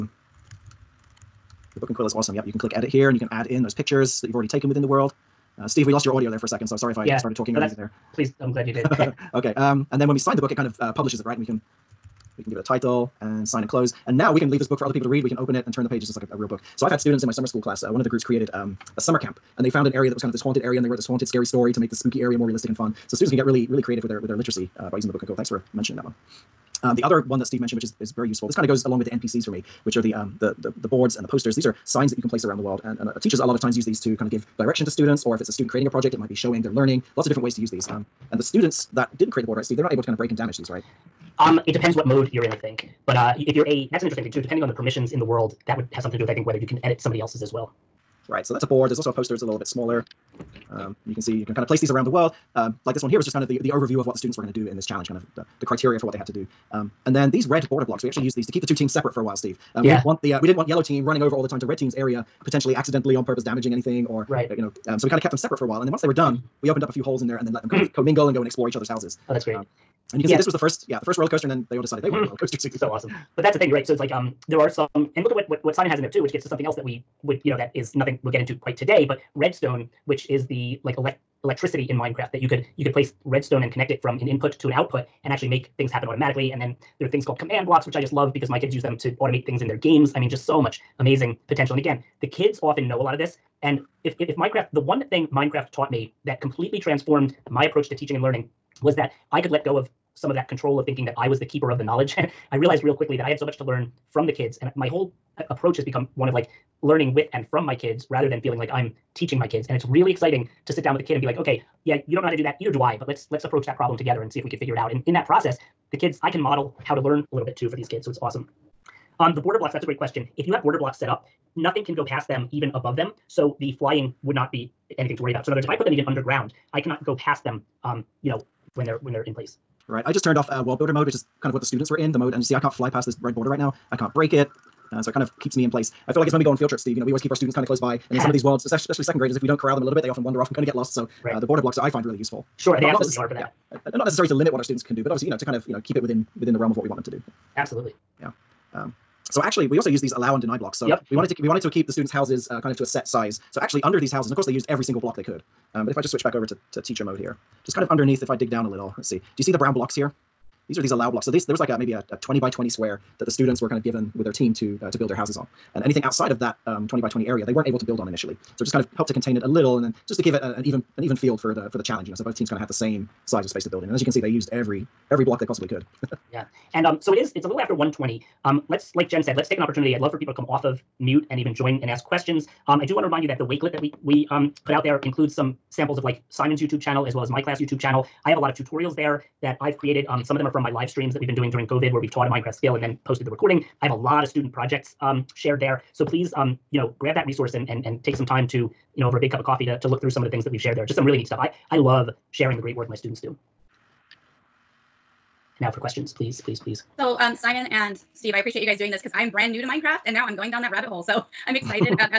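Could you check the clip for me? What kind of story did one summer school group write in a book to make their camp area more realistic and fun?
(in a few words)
haunted scary story.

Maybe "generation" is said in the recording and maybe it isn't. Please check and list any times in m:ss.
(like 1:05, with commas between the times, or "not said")
not said.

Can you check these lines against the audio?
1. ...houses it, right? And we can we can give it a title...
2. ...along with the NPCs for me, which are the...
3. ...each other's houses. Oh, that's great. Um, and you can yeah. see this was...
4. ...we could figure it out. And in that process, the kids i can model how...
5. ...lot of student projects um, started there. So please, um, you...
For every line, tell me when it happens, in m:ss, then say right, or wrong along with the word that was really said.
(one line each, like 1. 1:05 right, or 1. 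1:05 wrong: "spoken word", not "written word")
1. 0:10 wrong: "publishes", not "houses"
2. 0:28 right
3. 1:08 right
4. 1:54 right
5. 3:13 wrong: "shared", not "started".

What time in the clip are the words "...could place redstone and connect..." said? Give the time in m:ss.
1:22.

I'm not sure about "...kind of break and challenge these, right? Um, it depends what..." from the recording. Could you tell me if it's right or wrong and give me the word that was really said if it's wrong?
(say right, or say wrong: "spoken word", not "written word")
wrong: "damage", not "challenge".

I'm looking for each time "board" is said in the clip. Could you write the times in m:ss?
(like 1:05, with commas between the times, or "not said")
0:30, 0:39, 0:48.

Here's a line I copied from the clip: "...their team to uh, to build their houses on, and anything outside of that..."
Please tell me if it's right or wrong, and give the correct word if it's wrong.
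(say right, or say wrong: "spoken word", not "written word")
right.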